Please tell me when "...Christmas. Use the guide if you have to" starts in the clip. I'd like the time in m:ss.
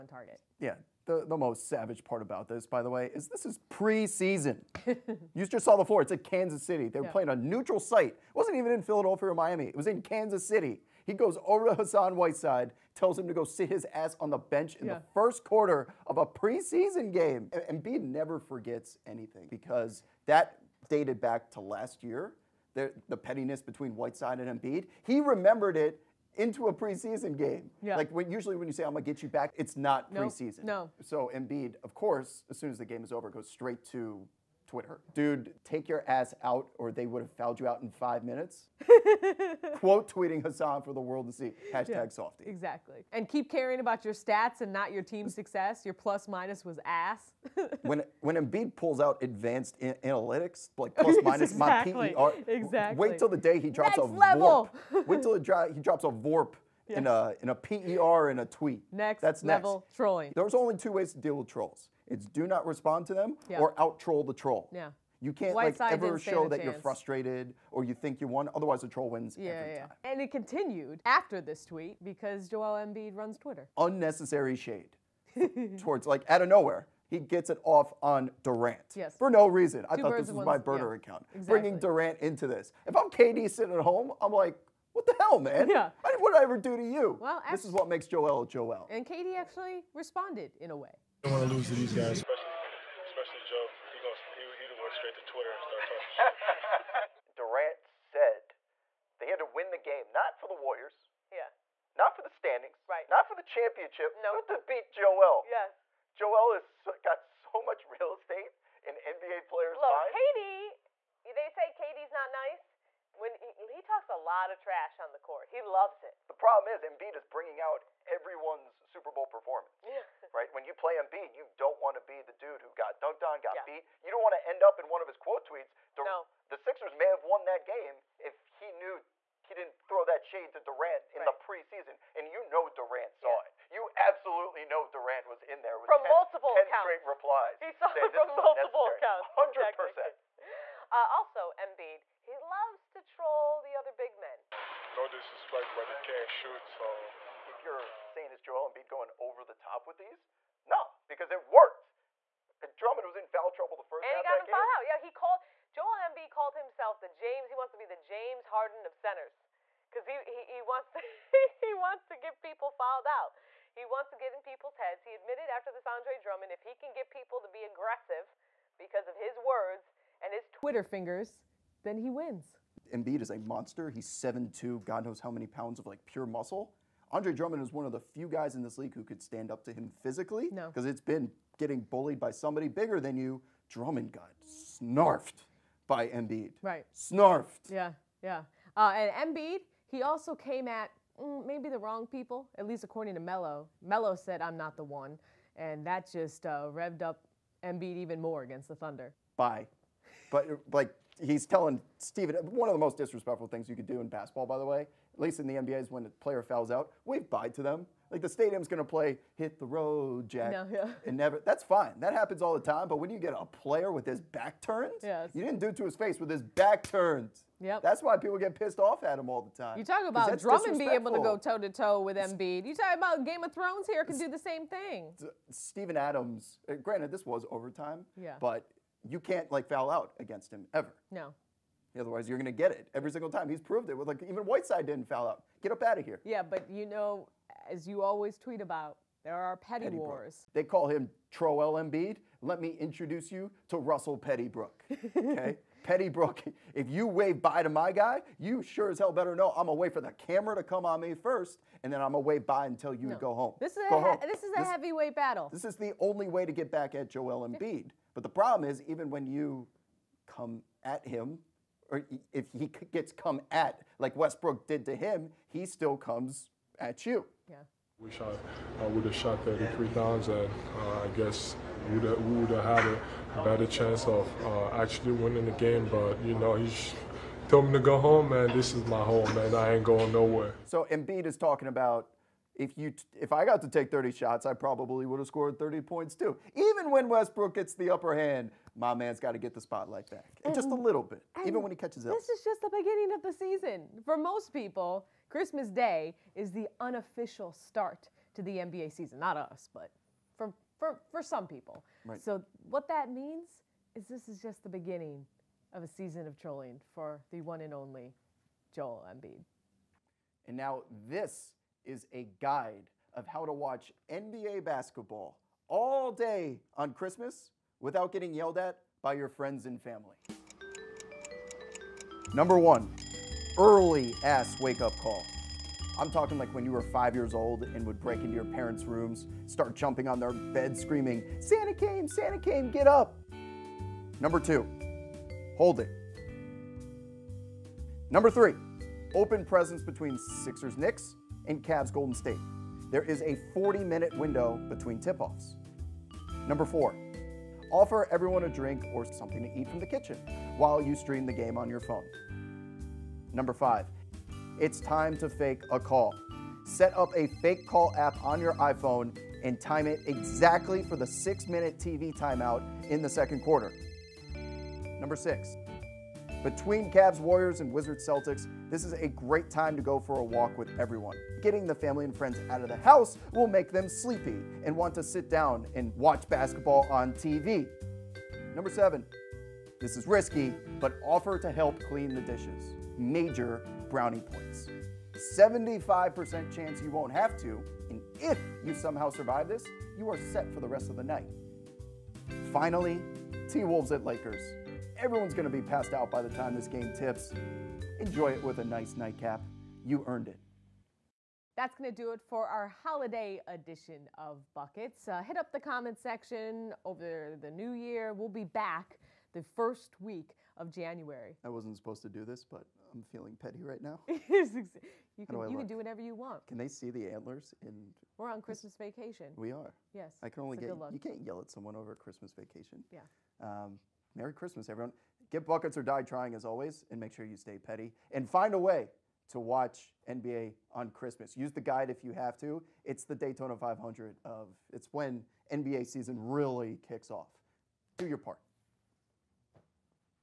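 7:10.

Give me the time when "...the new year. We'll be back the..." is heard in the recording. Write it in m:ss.
6:47.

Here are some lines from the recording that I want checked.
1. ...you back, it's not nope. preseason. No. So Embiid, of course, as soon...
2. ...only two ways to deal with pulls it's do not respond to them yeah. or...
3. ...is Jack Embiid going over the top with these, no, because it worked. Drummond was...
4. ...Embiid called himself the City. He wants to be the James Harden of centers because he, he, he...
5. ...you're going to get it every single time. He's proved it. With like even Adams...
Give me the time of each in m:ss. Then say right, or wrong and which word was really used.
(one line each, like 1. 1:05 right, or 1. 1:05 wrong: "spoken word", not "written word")
1. 0:29 right
2. 1:00 wrong: "trolls", not "pulls"
3. 2:28 wrong: "Joel", not "Jack"
4. 2:36 wrong: "James", not "City"
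5. 3:52 wrong: "Whiteside", not "Adams".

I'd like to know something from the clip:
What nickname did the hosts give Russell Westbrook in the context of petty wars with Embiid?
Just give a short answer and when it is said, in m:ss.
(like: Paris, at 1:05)
Russell Pettybrook, at 4:03.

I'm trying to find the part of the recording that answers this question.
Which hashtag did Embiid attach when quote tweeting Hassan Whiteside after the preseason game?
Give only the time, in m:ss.
0:42.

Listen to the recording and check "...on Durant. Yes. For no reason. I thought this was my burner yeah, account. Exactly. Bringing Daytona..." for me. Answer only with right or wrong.
wrong.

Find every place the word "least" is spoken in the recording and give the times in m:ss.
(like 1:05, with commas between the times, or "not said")
3:12, 3:25.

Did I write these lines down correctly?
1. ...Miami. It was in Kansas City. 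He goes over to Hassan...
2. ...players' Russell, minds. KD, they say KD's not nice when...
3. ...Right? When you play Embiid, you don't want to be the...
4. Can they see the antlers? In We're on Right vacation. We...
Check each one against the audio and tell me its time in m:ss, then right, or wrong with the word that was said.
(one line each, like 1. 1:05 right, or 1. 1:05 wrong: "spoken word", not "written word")
1. 0:09 right
2. 1:49 wrong: "Look", not "Russell"
3. 2:00 right
4. 6:56 wrong: "Christmas", not "Right".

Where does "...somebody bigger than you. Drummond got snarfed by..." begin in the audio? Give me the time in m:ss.
3:02.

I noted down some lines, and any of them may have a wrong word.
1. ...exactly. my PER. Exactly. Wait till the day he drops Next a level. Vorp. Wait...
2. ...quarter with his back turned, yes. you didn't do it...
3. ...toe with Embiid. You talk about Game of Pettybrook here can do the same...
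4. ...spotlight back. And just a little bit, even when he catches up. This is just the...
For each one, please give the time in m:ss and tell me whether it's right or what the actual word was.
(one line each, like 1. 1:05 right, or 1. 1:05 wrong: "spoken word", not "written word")
1. 0:51 right
2. 3:33 wrong: "player", not "quarter"
3. 3:41 wrong: "Thrones", not "Pettybrook"
4. 4:49 right.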